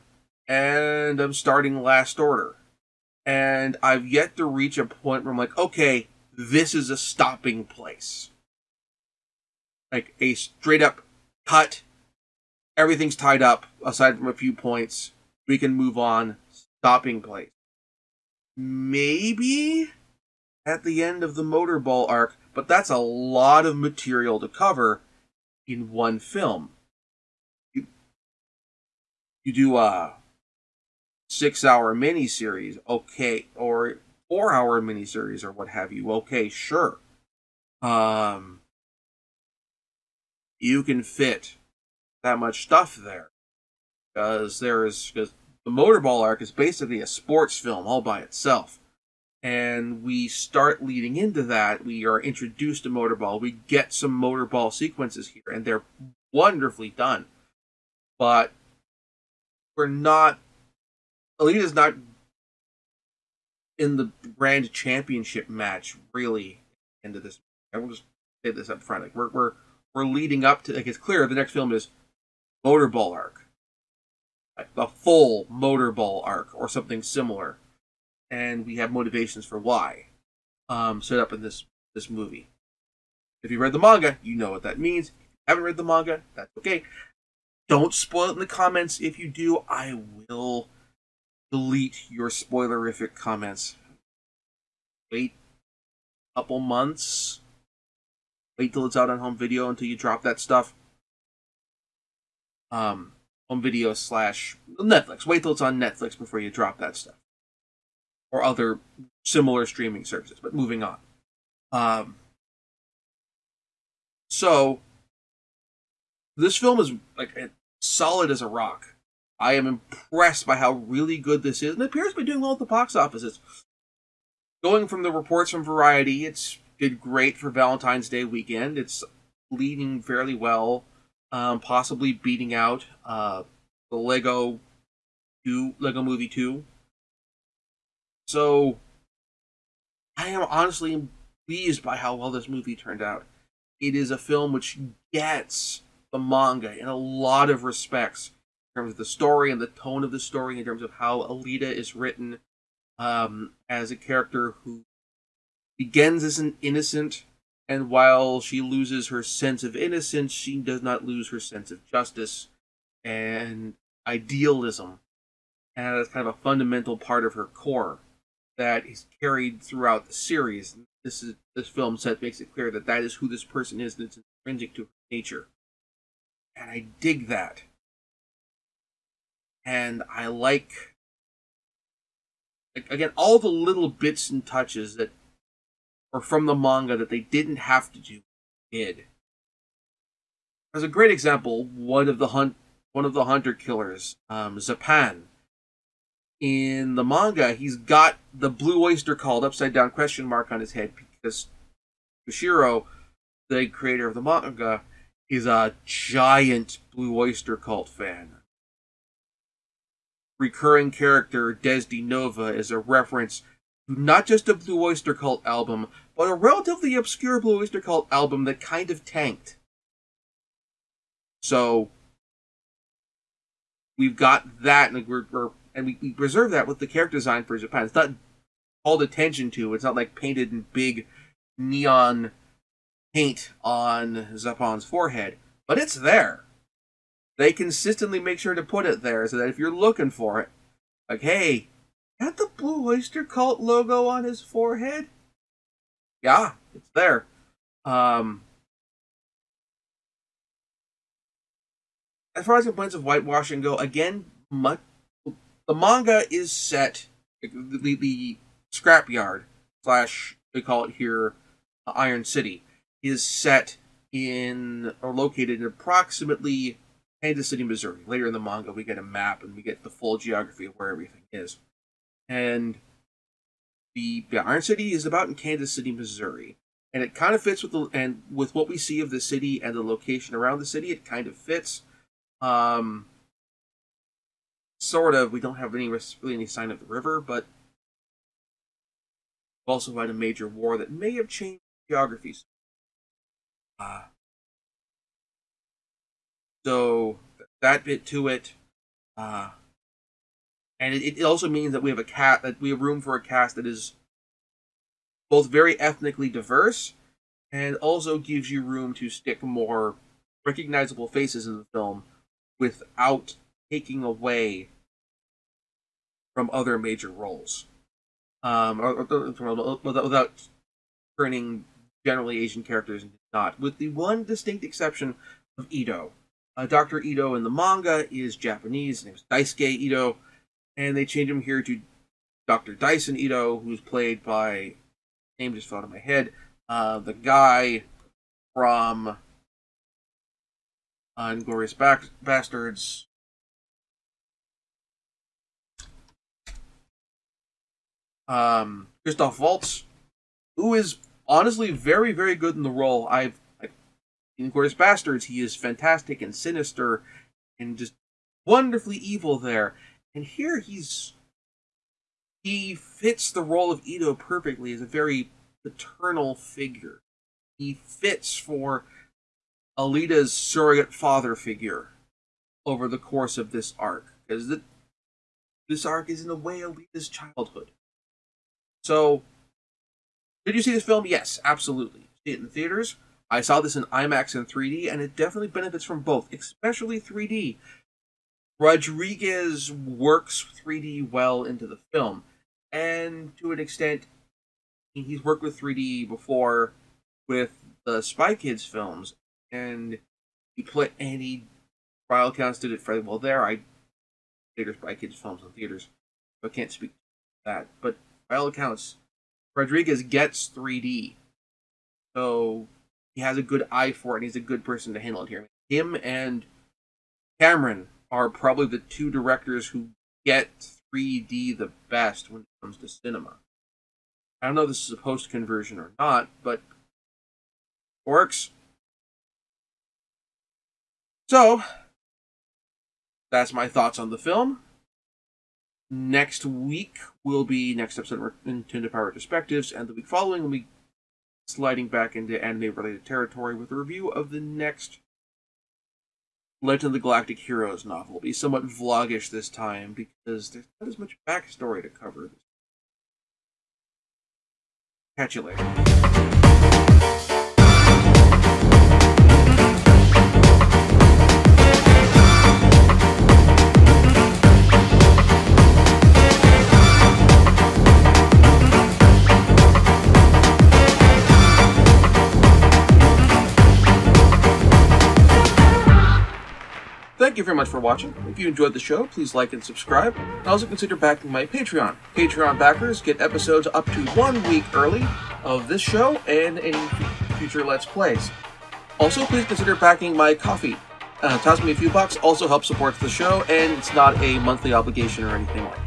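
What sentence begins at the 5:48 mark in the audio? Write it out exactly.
Um, Christoph Waltz, who is honestly very, very good in the role.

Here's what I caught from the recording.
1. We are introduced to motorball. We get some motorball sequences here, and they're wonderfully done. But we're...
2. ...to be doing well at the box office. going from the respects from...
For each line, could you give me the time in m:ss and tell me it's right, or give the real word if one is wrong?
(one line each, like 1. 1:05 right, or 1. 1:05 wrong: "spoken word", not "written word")
1. 0:51 right
2. 2:02 wrong: "reports", not "respects".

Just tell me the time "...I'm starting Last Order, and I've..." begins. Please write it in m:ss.
0:01.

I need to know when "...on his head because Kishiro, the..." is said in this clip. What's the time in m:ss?
3:20.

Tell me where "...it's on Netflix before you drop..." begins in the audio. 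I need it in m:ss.
1:45.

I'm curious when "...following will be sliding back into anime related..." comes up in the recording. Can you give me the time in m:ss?
7:20.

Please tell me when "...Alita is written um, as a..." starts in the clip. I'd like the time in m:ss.
2:31.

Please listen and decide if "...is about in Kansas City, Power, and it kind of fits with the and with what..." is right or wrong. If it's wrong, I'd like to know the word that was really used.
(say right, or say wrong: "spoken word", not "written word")
wrong: "Missouri", not "Power".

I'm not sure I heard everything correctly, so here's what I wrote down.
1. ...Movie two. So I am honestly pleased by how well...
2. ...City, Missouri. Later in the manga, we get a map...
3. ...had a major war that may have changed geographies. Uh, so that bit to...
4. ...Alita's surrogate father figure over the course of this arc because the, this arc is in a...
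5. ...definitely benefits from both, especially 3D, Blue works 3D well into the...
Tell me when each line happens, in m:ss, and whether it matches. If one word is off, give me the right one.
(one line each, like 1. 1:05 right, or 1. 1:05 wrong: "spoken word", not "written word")
1. 2:16 right
2. 4:27 right
3. 4:49 right
4. 6:09 right
5. 6:25 wrong: "Rodriguez", not "Blue".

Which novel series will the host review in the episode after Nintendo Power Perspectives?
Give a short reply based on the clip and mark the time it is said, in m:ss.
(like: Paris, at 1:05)
Legend of the Galactic Heroes, at 7:26.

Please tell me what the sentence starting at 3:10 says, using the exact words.
As a great example, one of the hunt one of the hunter killers, um, Zapan.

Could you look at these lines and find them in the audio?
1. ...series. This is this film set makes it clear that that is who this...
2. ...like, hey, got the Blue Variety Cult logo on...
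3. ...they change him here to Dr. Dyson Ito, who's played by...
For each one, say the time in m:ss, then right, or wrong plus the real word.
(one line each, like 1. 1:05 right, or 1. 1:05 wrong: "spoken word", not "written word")
1. 2:50 right
2. 4:01 wrong: "Oyster", not "Variety"
3. 5:30 right.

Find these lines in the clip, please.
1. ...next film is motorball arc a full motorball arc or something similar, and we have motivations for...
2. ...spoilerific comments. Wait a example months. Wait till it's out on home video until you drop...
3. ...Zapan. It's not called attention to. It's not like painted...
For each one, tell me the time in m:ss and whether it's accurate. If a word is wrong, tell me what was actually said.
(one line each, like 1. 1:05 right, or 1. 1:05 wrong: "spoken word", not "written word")
1. 1:11 right
2. 1:32 wrong: "couple", not "example"
3. 3:47 right.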